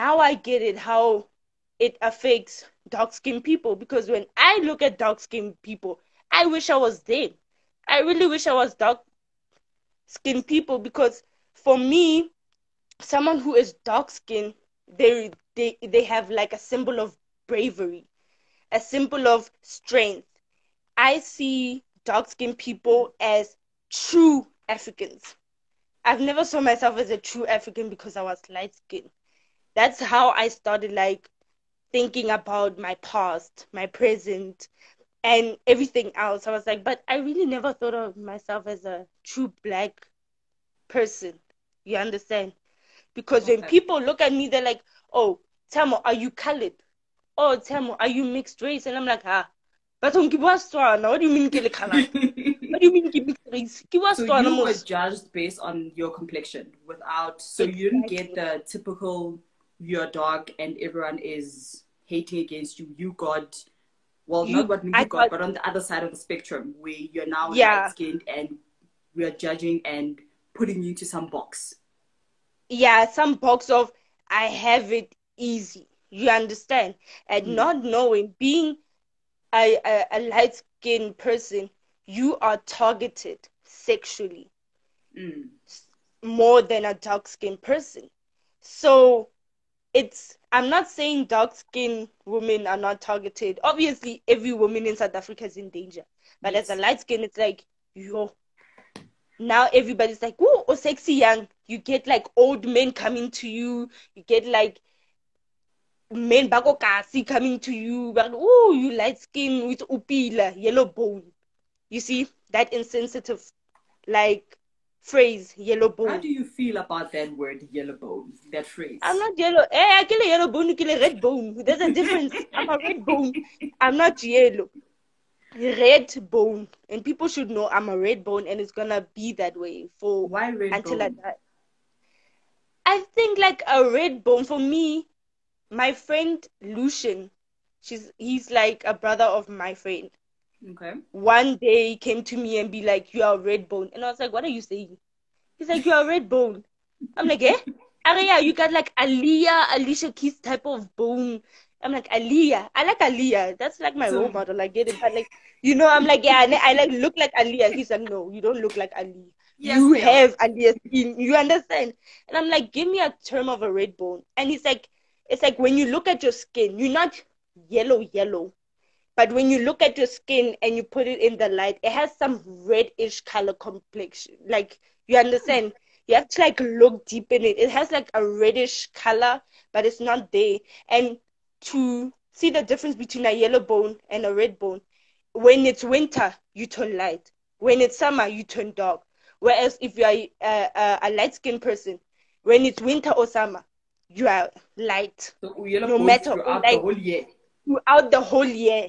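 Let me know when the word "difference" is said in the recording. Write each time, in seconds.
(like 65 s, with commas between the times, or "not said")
121 s, 182 s.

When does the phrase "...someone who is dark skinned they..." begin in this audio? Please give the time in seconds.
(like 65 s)
13 s.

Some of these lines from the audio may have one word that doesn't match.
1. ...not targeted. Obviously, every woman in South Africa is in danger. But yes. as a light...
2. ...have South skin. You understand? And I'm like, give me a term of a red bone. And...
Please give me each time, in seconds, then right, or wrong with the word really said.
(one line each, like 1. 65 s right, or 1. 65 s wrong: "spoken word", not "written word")
1. 92 s right
2. 159 s wrong: "Aaliyah", not "South".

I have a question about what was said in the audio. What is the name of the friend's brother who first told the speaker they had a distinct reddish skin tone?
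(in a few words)
Lucian.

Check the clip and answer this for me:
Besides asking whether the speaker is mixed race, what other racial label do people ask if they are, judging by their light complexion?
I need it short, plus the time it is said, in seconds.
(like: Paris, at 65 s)
Coloured, at 46 s.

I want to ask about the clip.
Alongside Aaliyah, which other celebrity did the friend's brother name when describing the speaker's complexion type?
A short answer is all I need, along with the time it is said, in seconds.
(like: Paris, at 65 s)
Alicia Keys, at 149 s.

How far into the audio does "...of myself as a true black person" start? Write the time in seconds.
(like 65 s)
37 s.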